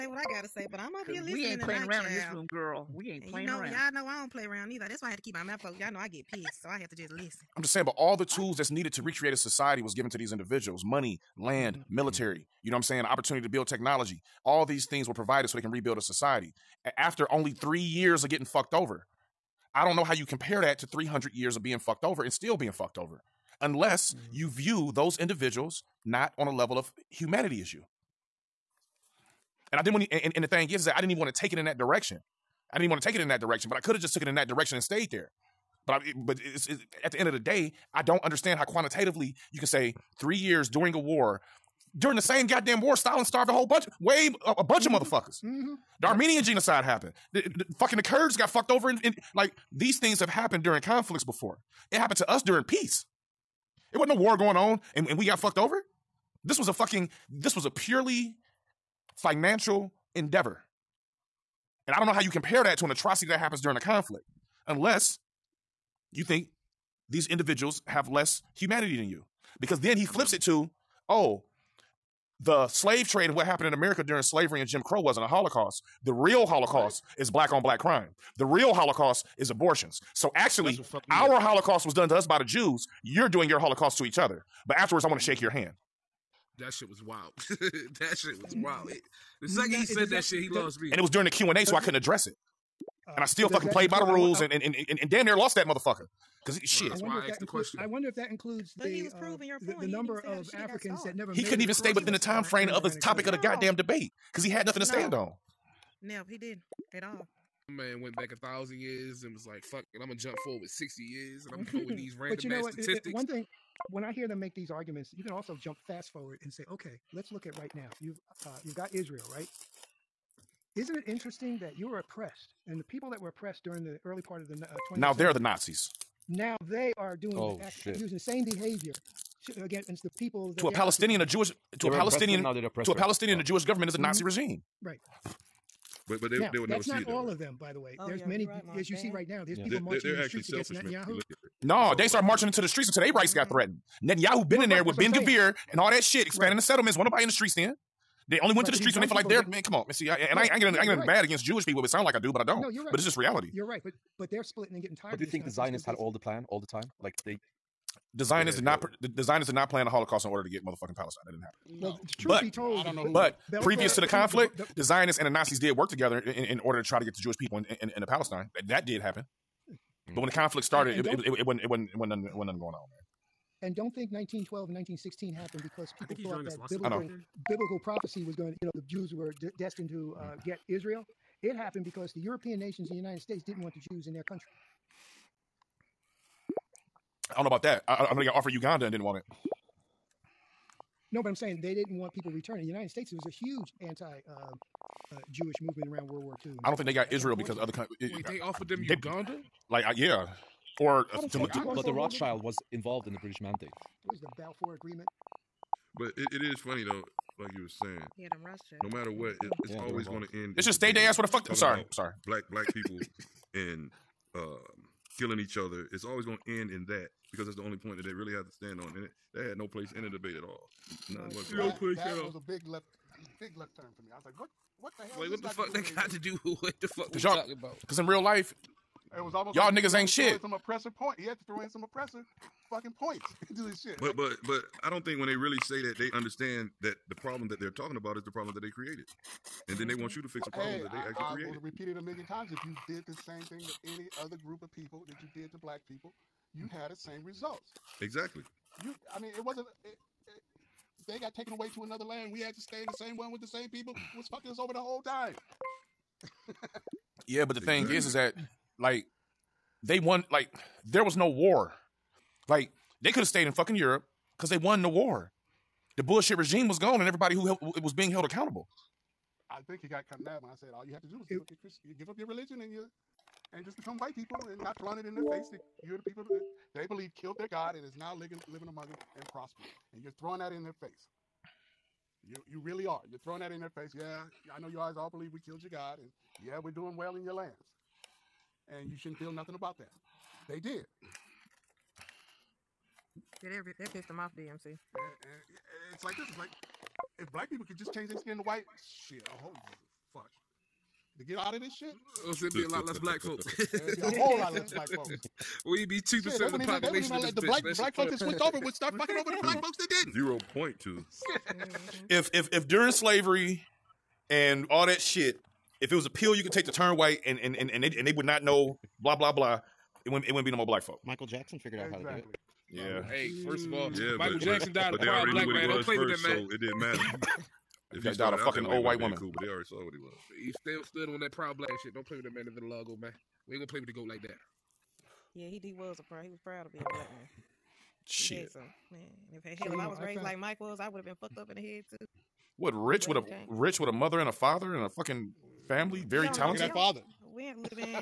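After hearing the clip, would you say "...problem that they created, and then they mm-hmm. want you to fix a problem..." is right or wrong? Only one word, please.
right.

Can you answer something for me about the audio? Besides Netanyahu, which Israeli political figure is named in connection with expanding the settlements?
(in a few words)
Ben Gvir.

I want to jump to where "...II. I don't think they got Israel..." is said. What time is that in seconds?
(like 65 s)
196 s.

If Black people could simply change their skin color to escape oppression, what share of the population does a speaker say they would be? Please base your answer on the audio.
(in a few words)
2 percent.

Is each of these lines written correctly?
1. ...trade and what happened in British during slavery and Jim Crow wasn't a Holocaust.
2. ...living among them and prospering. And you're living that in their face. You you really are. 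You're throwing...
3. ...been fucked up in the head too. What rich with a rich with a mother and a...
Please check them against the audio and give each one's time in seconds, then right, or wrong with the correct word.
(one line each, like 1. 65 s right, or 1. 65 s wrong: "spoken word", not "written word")
1. 73 s wrong: "America", not "British"
2. 278 s wrong: "throwing", not "living"
3. 341 s right.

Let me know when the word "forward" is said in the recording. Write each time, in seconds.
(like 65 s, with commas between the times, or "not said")
110 s, 116 s.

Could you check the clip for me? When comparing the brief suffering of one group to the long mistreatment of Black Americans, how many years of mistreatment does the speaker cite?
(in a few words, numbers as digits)
300 years.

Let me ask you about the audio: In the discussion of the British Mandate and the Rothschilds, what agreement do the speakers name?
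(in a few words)
Balfour Agreement.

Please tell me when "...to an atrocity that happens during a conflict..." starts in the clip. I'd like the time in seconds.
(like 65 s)
62 s.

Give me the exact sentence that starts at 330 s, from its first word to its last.
He still stood on that proud black shit.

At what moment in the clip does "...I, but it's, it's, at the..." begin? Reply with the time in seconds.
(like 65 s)
35 s.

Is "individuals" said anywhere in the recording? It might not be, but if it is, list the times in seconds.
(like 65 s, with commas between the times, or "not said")
10 s, 25 s, 67 s.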